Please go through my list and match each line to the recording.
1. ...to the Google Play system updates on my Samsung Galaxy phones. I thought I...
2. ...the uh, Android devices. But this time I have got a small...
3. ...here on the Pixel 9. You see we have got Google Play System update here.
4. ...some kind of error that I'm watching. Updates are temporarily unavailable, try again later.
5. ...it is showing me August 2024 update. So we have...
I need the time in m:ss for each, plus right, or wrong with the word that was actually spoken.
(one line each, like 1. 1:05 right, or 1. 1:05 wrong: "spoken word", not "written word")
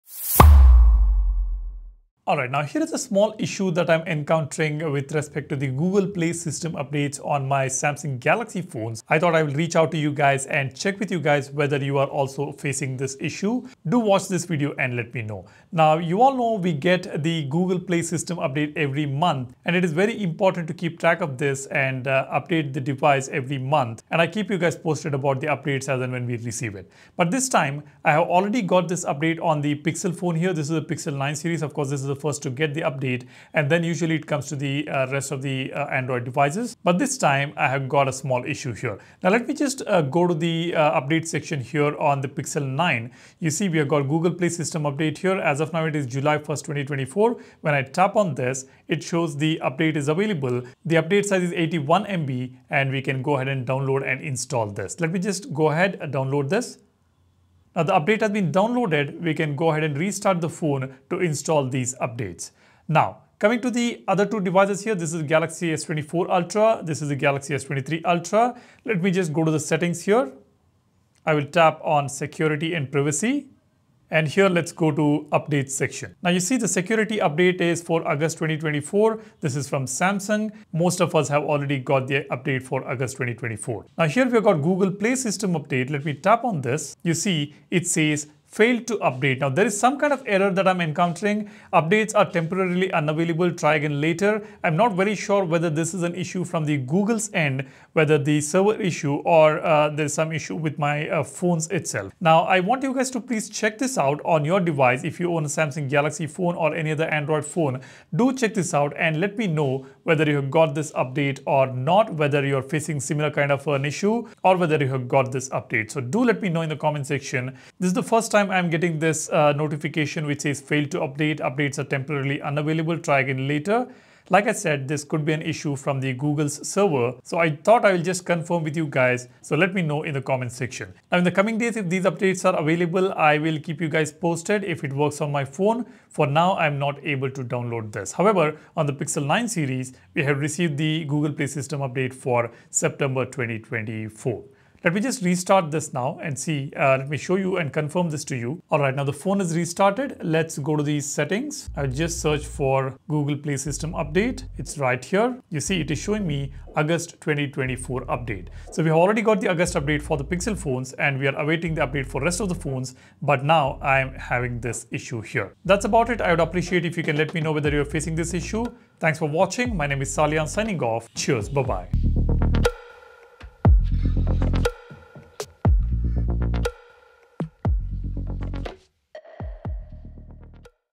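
1. 0:05 right
2. 0:35 right
3. 0:41 right
4. 1:29 wrong: "encountering", not "watching"
5. 2:35 right.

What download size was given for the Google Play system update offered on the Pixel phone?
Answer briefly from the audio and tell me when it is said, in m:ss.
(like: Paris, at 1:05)
81 MB, at 0:51.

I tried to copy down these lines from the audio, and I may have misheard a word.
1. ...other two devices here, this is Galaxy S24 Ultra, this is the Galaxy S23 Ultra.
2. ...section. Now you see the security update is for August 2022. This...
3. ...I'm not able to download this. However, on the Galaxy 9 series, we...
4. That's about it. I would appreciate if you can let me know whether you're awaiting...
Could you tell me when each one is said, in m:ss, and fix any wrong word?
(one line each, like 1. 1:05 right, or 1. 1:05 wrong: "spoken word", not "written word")
1. 1:04 right
2. 1:15 wrong: "2024", not "2022"
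3. 2:16 wrong: "Pixel", not "Galaxy"
4. 2:45 wrong: "facing", not "awaiting".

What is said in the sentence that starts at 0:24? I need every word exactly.
And I keep you guys posted about the updates as and when we receive it.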